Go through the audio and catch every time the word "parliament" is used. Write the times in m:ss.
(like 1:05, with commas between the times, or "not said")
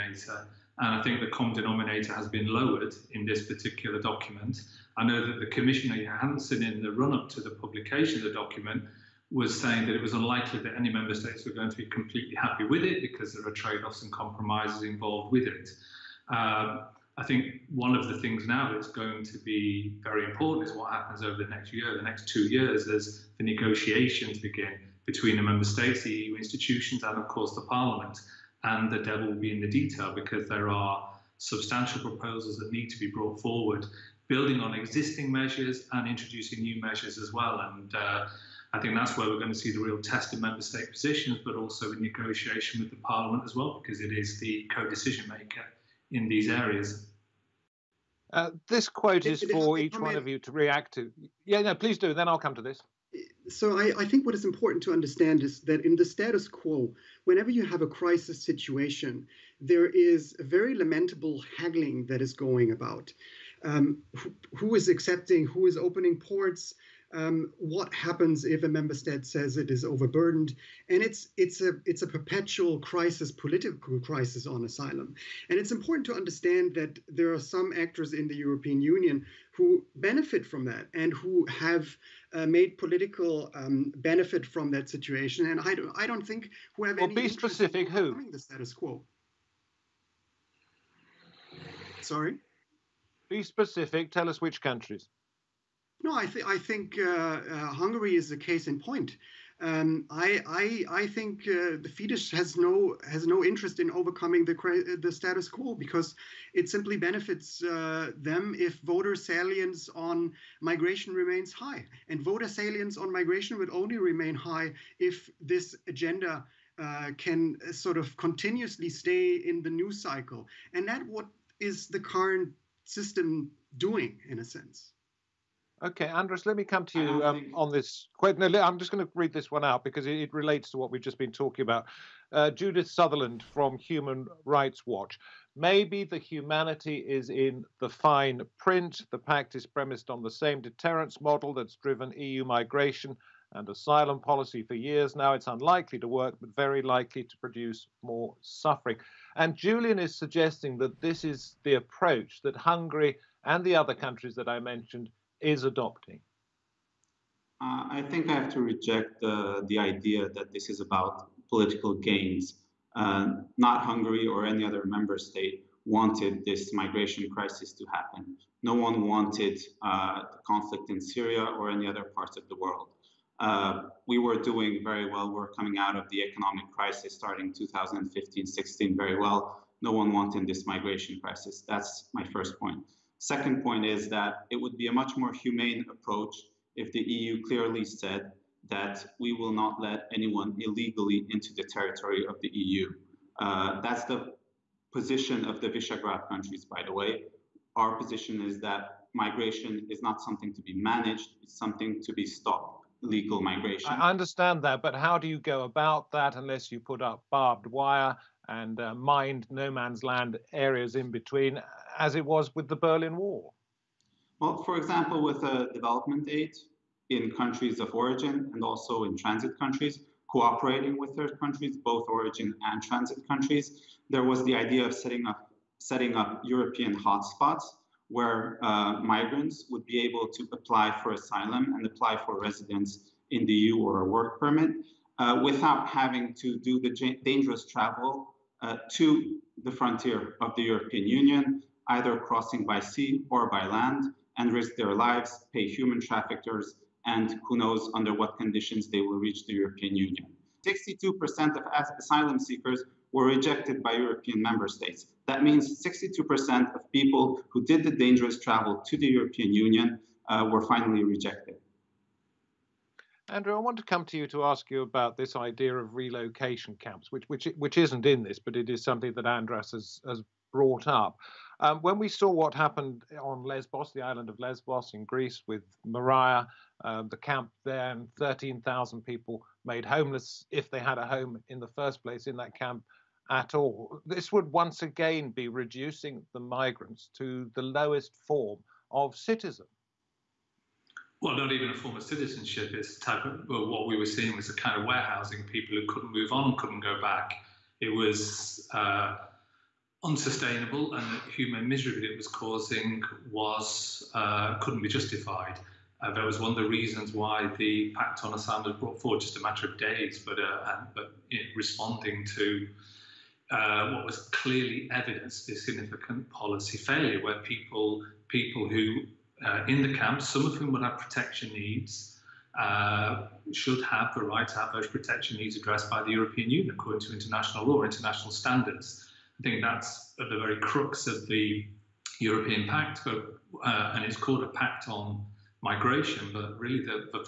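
0:27, 0:42.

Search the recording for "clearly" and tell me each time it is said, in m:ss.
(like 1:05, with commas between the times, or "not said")
3:07, 5:14.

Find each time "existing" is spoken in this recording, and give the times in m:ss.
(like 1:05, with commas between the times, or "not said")
0:34.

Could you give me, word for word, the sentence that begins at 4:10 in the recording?
62% of asylum seekers were rejected by European member states.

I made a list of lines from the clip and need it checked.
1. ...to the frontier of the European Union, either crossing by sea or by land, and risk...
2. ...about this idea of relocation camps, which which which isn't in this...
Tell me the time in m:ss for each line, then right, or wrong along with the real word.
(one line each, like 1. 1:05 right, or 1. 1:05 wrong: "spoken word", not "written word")
1. 3:58 right
2. 4:24 right.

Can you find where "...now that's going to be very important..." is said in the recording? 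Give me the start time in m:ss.
0:18.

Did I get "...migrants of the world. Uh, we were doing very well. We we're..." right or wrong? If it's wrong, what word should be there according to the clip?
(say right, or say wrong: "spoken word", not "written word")
wrong: "parts", not "migrants".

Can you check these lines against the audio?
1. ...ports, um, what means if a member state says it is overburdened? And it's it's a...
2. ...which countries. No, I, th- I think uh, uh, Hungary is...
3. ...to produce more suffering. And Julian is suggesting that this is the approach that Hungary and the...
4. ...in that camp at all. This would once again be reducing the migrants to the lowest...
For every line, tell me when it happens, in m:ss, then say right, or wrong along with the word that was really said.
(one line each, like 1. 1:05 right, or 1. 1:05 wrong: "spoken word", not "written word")
1. 1:06 wrong: "happens", not "means"
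2. 1:34 right
3. 2:27 right
4. 4:42 right.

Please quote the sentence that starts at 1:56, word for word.
Uh, can sort of continuously stay in the news cycle, and that what is the current system doing in a sense.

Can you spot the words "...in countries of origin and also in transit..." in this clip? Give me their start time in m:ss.
3:37.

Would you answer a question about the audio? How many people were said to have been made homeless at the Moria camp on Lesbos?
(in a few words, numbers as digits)
13,000.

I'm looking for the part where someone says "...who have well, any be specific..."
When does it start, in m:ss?
1:26.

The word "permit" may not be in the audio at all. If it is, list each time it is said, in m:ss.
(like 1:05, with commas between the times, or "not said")
3:54.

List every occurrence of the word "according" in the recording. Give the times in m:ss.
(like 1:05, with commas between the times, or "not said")
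5:26.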